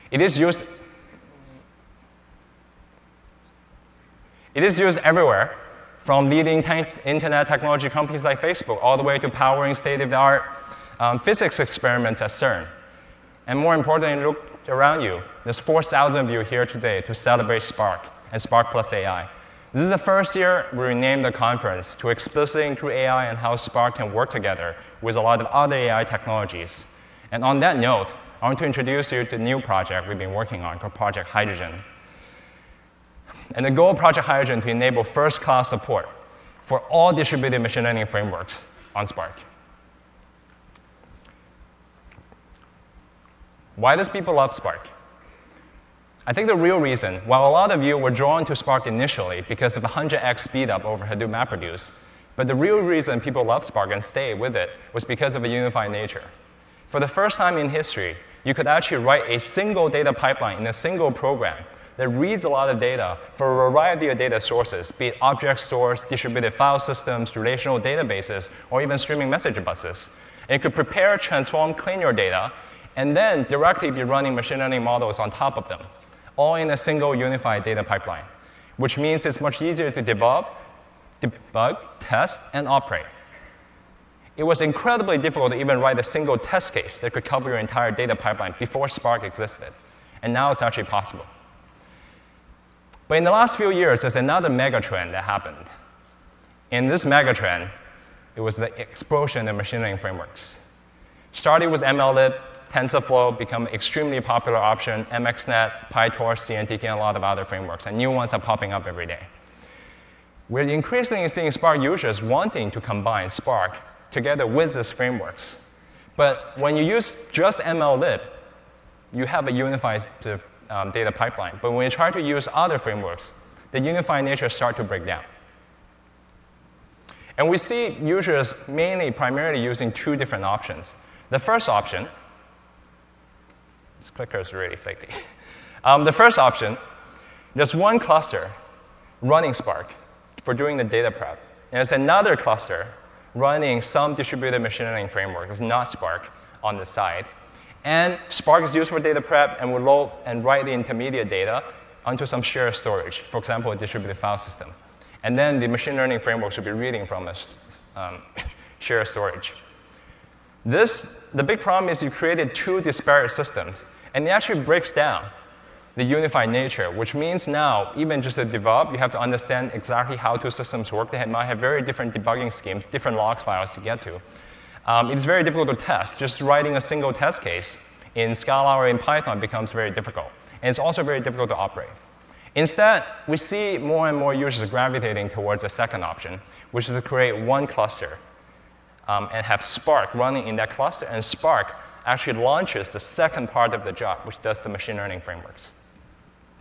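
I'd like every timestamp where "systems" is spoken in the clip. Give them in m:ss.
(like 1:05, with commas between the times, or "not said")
1:06, 2:34, 2:43, 2:50.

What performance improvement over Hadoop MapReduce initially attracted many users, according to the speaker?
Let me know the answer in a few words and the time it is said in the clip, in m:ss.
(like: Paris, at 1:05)
100x speedup, at 0:49.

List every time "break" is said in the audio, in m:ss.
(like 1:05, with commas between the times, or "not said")
2:04, 2:44.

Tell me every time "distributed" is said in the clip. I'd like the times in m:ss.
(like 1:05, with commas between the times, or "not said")
0:37, 1:06, 2:24, 2:33.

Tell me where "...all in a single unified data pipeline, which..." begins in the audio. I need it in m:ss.
1:16.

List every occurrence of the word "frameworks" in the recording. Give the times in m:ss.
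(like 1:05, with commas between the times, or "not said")
0:38, 1:39, 1:47, 1:54, 2:02, 2:25, 2:36, 3:15.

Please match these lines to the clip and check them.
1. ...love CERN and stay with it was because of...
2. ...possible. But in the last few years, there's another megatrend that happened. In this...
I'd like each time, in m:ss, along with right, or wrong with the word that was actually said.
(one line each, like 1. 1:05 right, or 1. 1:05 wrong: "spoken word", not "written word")
1. 0:53 wrong: "Spark", not "CERN"
2. 1:30 right.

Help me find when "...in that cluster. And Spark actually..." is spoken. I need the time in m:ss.
3:10.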